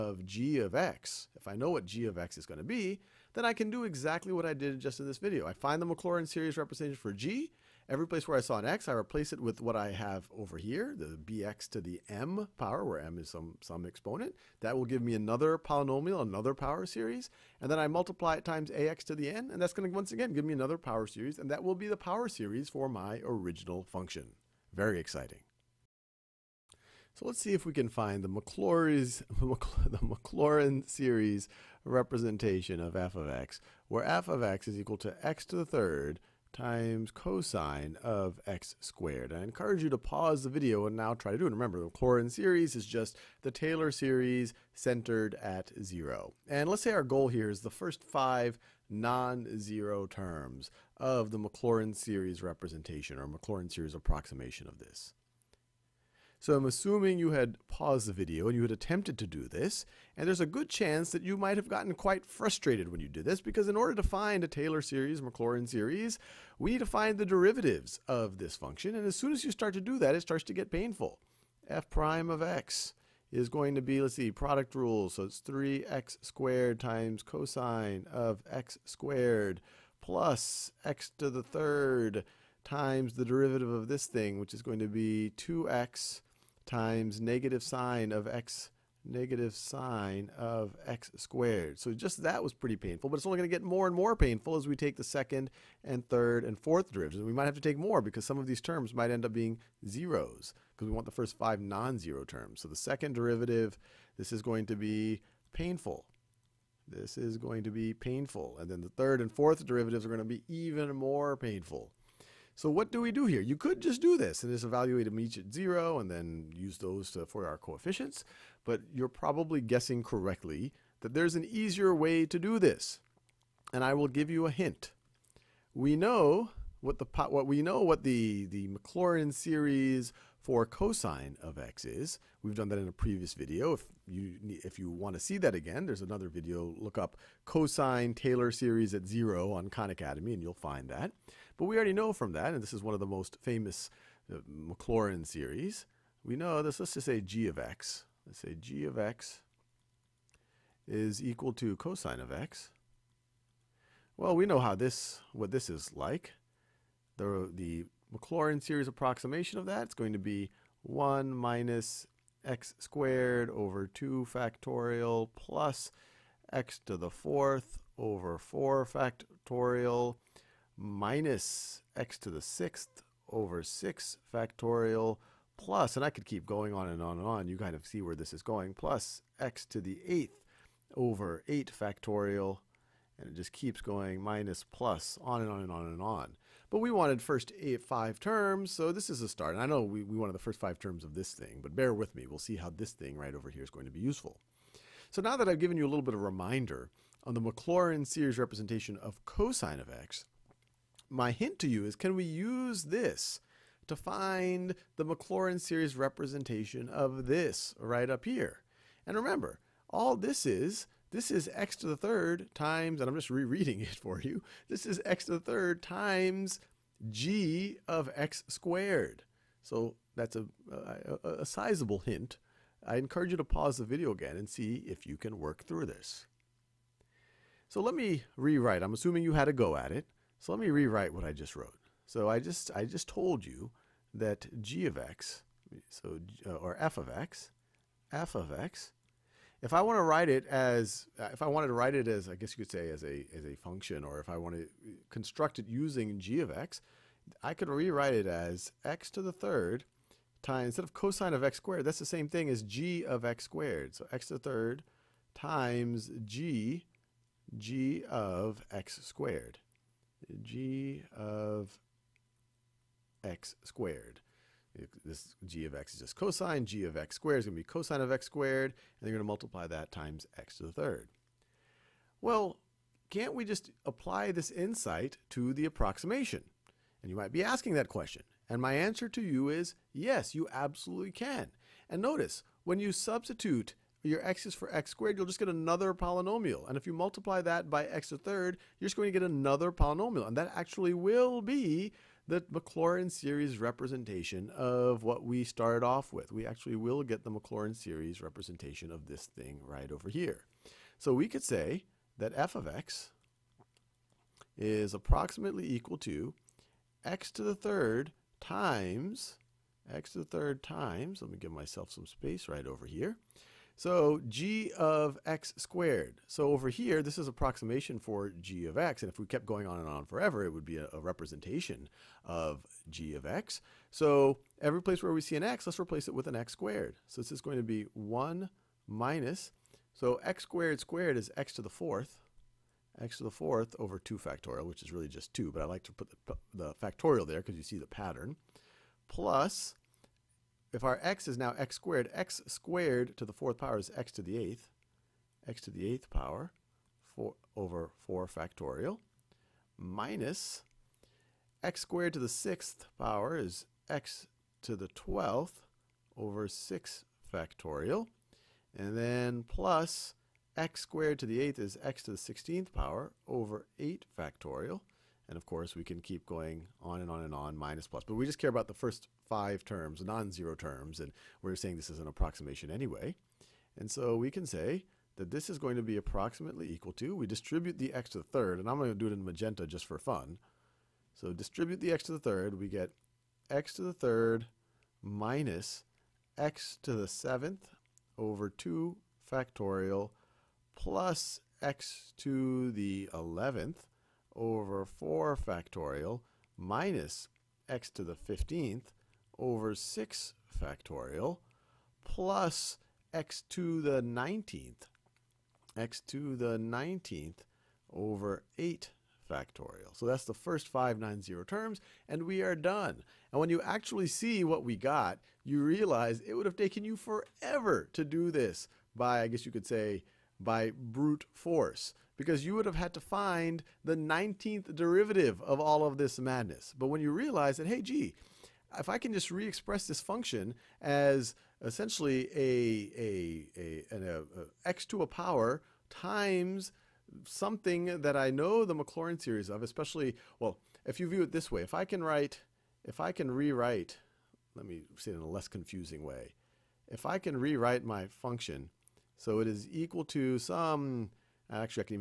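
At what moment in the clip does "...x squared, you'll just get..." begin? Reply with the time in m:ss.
4:44.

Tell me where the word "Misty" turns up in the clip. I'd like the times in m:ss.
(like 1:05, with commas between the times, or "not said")
not said.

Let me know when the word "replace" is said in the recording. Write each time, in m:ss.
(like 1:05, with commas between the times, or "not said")
0:08, 5:25.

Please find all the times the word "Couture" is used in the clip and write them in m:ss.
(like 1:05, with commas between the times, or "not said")
not said.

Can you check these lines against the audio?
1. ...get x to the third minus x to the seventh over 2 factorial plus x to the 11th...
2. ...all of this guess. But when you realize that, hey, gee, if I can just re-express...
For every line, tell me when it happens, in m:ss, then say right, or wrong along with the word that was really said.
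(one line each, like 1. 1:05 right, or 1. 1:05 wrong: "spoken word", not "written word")
1. 6:22 right
2. 7:05 wrong: "madness", not "guess".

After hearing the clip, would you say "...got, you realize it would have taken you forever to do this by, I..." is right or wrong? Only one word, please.
right.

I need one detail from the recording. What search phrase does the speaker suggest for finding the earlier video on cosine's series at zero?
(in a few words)
cosine Taylor series at 0.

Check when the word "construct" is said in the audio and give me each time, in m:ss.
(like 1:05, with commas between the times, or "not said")
4:05.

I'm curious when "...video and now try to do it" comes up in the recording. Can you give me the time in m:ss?
0:40.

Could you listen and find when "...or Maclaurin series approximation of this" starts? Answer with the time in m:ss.
0:53.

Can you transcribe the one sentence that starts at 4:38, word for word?
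And my answer to you is yes, you absolutely can.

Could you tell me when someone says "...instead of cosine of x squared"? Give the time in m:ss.
4:10.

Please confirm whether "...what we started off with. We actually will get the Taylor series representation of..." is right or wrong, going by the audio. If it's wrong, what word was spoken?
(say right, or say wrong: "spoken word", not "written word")
wrong: "Maclaurin", not "Taylor".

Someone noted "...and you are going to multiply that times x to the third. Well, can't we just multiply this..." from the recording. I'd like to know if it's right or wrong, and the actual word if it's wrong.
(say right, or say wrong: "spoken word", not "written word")
wrong: "apply", not "multiply".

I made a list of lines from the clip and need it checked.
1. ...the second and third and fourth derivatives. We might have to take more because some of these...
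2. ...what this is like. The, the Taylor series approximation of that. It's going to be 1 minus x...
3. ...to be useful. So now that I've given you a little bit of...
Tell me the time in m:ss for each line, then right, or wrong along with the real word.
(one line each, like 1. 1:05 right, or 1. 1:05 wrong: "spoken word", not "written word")
1. 1:34 right
2. 2:35 wrong: "Maclaurin", not "Taylor"
3. 3:13 right.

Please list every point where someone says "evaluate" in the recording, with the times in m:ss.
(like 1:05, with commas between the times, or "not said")
1:54.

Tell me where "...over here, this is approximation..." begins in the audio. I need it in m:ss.
5:16.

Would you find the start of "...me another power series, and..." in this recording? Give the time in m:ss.
0:20.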